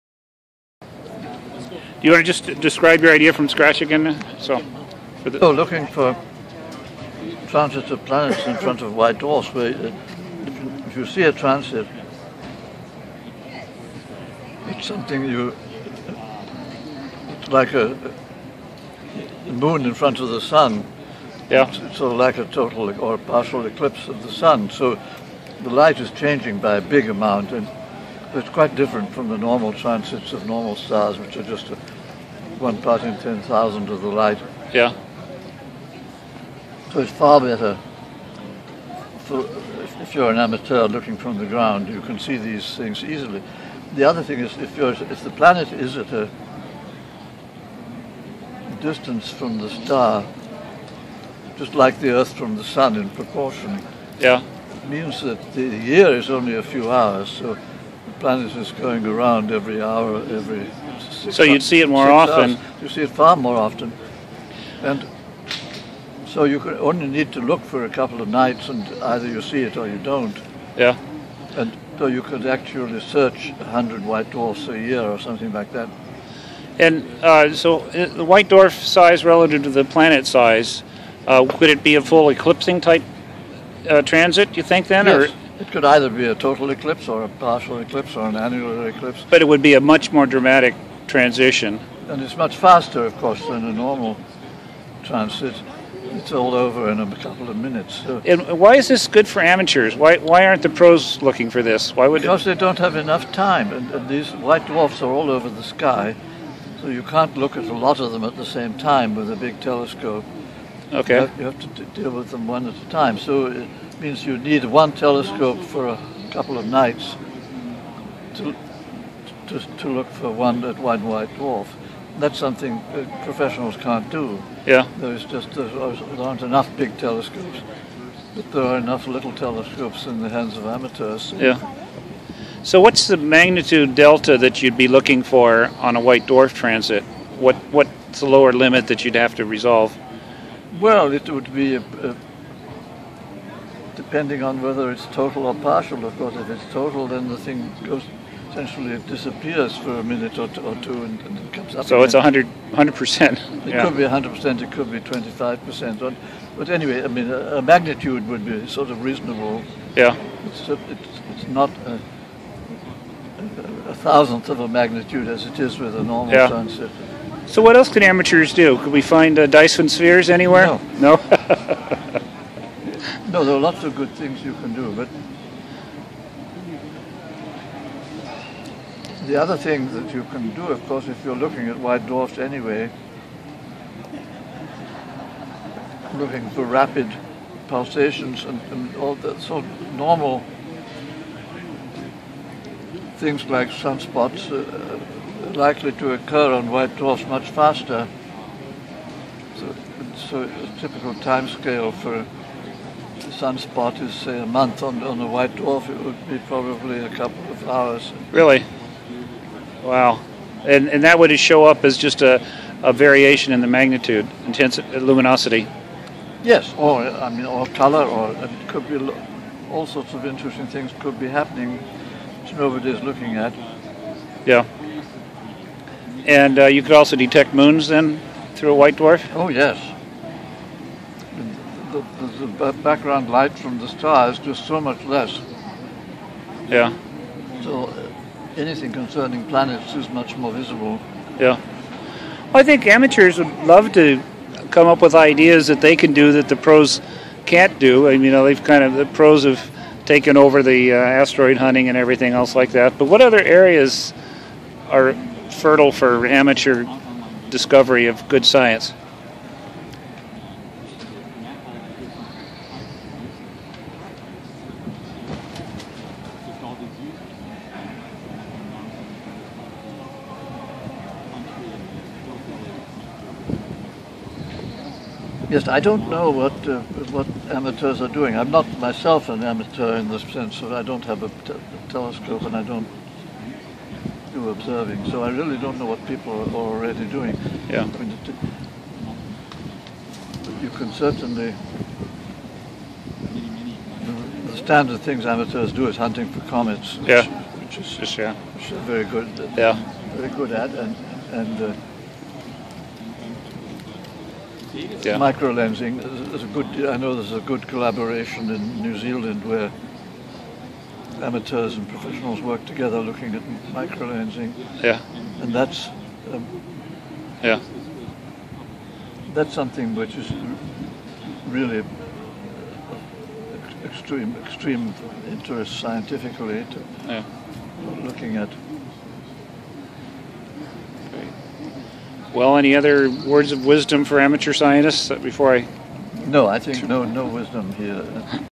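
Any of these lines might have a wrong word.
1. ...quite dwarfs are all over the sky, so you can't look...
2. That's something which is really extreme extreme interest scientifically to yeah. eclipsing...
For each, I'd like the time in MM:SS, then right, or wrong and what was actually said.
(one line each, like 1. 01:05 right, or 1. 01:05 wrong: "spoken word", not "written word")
1. 01:44 wrong: "white", not "quite"
2. 05:19 wrong: "looking", not "eclipsing".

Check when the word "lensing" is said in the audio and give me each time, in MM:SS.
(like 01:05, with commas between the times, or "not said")
05:05, 05:14.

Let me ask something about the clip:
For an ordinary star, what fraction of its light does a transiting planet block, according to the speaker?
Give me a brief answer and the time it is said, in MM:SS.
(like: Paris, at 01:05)
1 part in 10,000, at 00:32.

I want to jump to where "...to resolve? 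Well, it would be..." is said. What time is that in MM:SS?
02:19.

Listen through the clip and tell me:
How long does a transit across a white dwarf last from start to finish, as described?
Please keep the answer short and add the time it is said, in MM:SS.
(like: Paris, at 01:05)
A couple of minutes, at 01:36.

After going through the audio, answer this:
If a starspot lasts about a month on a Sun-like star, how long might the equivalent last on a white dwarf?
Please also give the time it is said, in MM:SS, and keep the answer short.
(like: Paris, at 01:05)
A couple of hours, at 03:26.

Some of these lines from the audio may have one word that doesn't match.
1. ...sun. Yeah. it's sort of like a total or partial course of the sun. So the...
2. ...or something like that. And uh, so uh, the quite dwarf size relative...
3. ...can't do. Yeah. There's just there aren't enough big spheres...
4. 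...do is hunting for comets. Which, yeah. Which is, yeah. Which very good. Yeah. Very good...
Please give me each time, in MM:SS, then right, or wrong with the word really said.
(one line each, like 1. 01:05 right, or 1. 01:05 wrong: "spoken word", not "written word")
1. 00:20 wrong: "eclipse", not "course"
2. 01:15 wrong: "white", not "quite"
3. 02:03 wrong: "telescopes", not "spheres"
4. 04:55 right.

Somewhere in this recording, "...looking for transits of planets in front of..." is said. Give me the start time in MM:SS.
00:05.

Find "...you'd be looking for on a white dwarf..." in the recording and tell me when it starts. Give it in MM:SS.
02:14.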